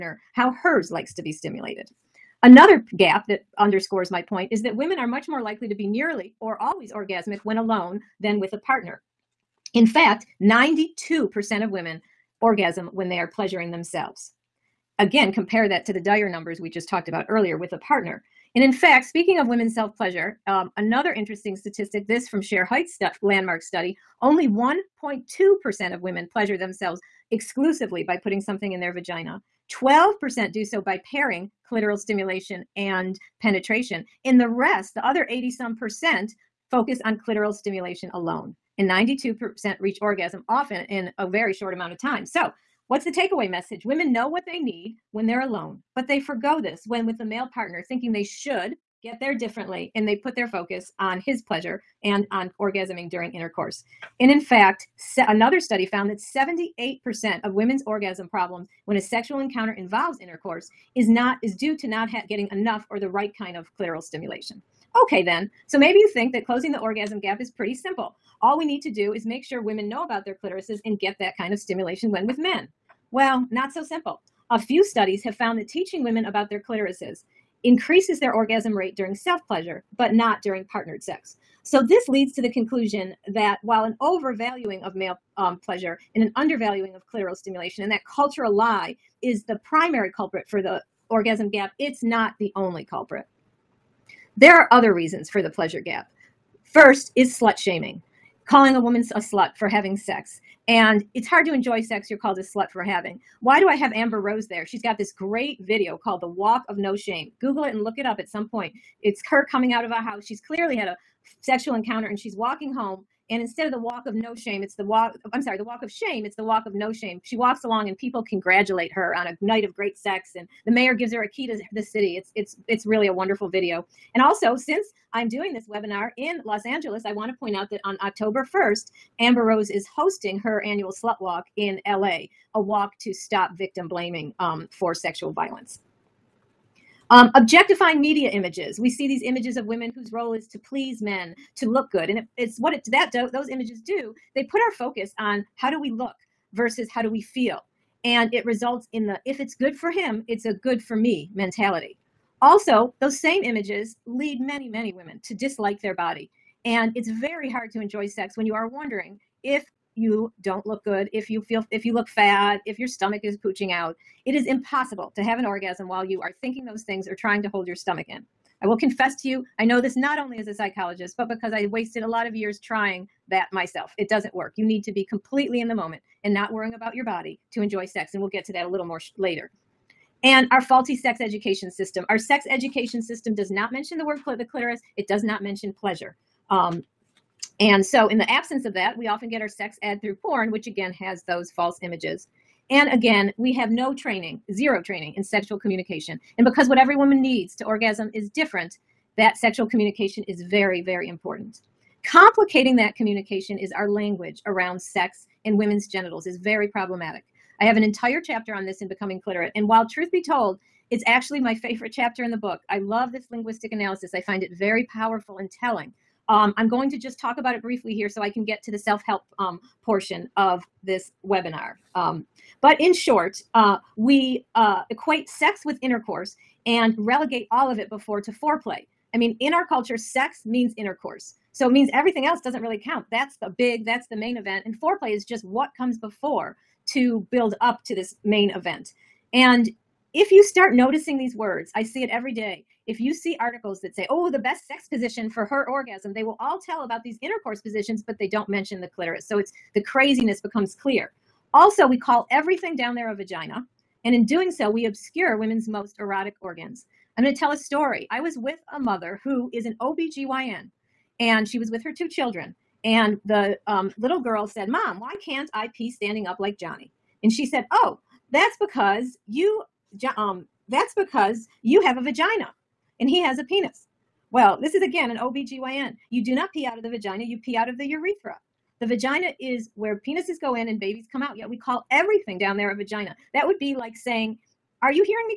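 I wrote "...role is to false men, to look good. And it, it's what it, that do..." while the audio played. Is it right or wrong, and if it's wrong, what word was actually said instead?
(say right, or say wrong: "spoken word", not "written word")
wrong: "please", not "false".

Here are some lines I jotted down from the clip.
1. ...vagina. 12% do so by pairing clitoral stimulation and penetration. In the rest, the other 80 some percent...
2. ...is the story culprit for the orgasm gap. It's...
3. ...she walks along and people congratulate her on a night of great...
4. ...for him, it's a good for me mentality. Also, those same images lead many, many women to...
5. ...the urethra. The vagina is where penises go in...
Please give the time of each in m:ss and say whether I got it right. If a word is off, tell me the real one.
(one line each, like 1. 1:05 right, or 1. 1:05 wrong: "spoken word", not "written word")
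1. 0:28 right
2. 1:29 wrong: "primary", not "story"
3. 1:57 right
4. 2:29 right
5. 4:37 right.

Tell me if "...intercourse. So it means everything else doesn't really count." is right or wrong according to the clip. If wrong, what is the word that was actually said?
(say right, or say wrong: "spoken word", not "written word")
right.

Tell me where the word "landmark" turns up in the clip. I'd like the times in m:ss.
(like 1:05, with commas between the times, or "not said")
0:23.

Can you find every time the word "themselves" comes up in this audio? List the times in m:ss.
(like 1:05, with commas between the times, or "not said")
0:13, 0:26.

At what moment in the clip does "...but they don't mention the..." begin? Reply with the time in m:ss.
4:08.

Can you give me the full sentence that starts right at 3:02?
Our sex education system does not mention the word cl- the clitoris, it does not mention pleasure.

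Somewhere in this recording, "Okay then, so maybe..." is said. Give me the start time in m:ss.
1:05.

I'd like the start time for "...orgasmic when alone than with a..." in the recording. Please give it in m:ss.
0:06.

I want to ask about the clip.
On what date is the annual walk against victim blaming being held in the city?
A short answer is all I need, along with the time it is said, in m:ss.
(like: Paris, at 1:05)
October 1st, at 2:08.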